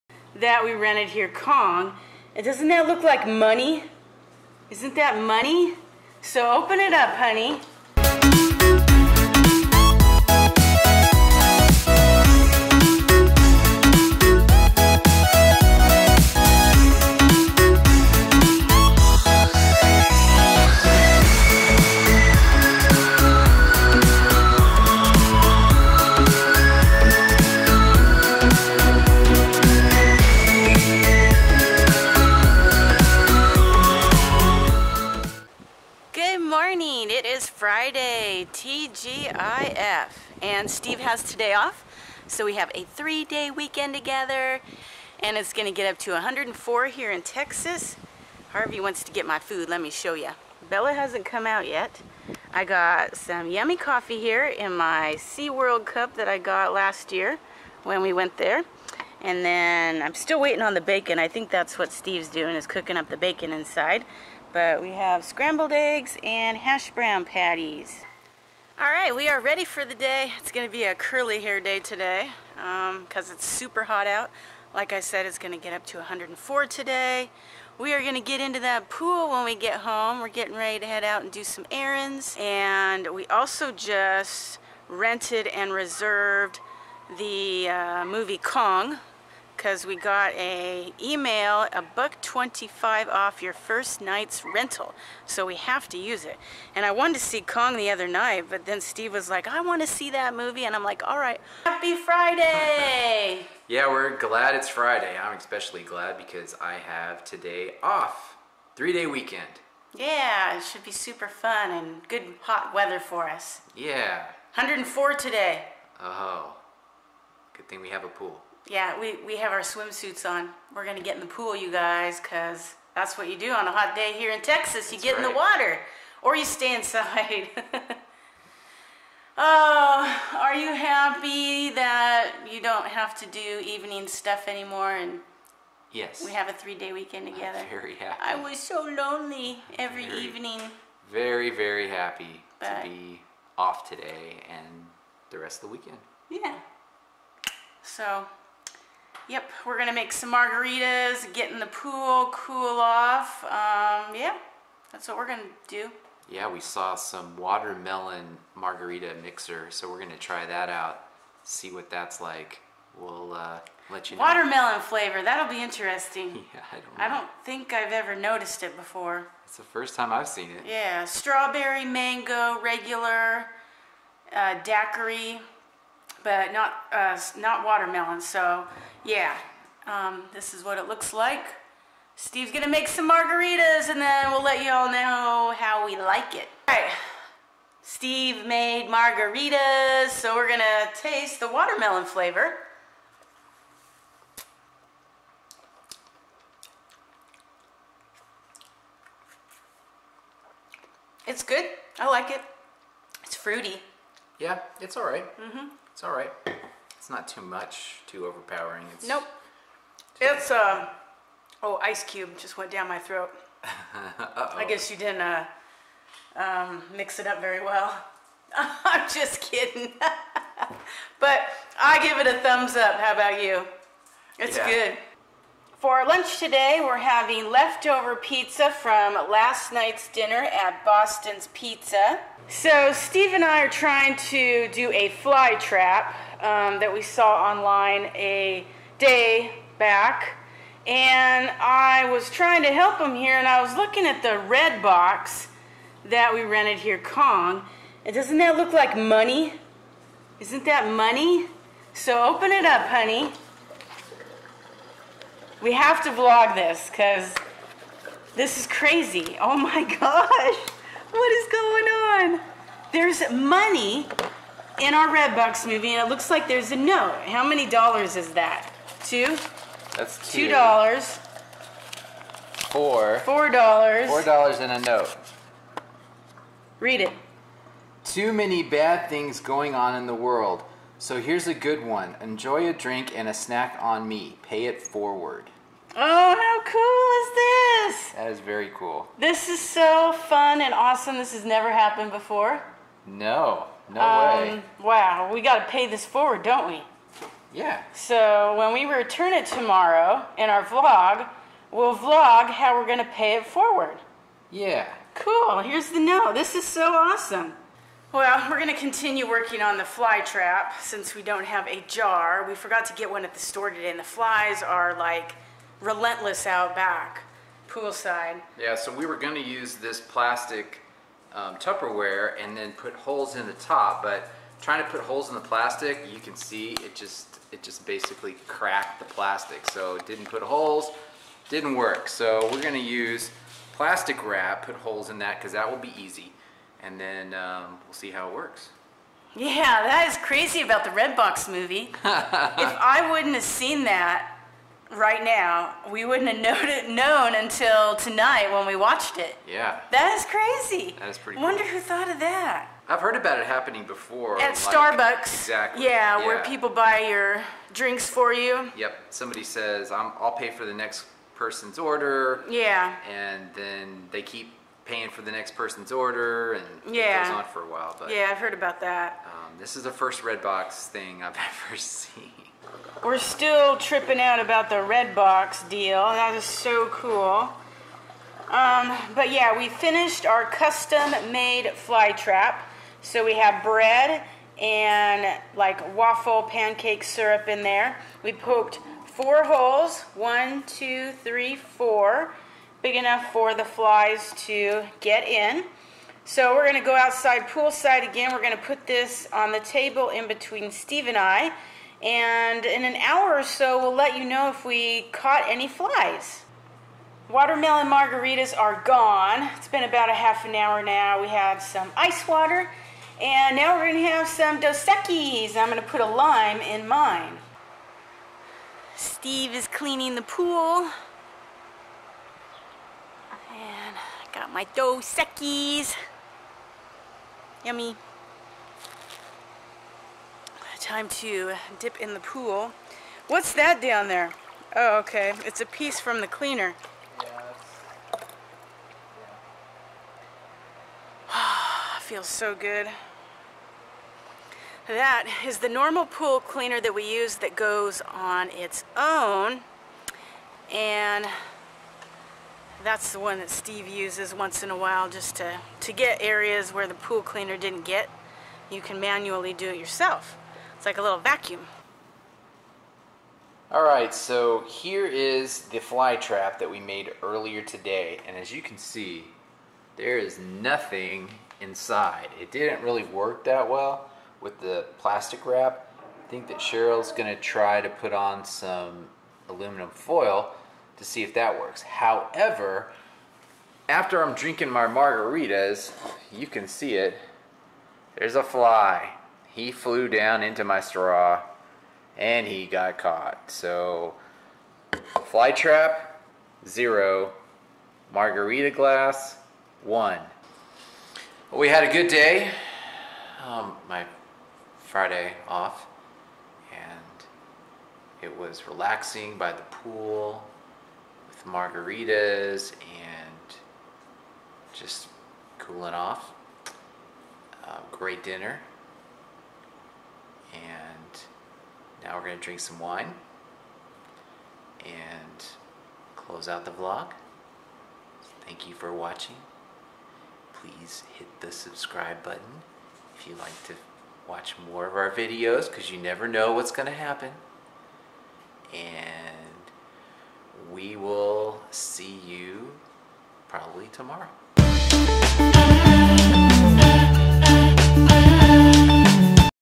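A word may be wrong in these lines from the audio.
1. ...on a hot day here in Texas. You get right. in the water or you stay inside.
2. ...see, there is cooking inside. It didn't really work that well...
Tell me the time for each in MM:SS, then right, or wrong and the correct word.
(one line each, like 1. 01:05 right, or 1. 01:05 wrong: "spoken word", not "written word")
1. 02:03 right
2. 07:48 wrong: "nothing", not "cooking".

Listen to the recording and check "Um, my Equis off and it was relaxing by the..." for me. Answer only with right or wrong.
wrong.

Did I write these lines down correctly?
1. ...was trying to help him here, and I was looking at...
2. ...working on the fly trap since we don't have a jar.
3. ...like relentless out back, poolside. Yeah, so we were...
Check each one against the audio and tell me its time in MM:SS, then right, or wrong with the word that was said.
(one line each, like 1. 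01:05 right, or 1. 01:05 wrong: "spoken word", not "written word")
1. 04:02 right
2. 05:09 right
3. 05:14 right.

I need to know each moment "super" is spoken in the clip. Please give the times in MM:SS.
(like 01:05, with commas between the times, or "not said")
01:13, 01:50.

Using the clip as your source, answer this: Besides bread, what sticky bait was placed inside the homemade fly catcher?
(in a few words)
Waffle pancake syrup.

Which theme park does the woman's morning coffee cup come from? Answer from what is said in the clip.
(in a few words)
SeaWorld.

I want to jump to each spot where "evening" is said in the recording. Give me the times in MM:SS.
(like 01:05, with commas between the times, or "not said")
02:13, 02:20.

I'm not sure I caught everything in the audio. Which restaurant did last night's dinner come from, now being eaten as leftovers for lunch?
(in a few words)
Boston's Pizza.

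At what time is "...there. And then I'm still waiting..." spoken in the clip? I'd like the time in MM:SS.
00:58.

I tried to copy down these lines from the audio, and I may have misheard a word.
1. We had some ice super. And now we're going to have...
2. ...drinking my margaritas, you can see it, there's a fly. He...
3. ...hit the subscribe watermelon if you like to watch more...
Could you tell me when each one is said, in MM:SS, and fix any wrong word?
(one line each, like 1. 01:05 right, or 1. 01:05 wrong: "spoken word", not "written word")
1. 06:51 wrong: "water", not "super"
2. 08:04 right
3. 08:51 wrong: "button", not "watermelon".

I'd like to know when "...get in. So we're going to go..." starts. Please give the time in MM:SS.
06:35.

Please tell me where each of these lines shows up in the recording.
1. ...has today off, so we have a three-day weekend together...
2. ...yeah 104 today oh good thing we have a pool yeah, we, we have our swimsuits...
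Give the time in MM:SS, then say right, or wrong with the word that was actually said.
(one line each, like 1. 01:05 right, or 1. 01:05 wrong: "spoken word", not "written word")
1. 00:41 right
2. 01:53 right.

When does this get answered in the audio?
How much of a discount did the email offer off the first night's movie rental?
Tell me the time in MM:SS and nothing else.
01:31.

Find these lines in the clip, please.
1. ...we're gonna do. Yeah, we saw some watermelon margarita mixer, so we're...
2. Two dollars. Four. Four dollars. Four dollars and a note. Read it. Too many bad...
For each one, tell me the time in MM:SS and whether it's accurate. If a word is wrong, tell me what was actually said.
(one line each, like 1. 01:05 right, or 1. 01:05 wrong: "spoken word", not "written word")
1. 02:35 right
2. 04:30 right.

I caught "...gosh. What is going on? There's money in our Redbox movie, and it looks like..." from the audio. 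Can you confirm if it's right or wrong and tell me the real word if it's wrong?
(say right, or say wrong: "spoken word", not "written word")
right.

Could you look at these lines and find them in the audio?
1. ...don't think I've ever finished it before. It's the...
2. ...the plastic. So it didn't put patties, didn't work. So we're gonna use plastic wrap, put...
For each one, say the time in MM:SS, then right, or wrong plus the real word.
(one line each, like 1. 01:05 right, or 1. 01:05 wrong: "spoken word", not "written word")
1. 02:47 wrong: "noticed", not "finished"
2. 05:28 wrong: "holes", not "patties".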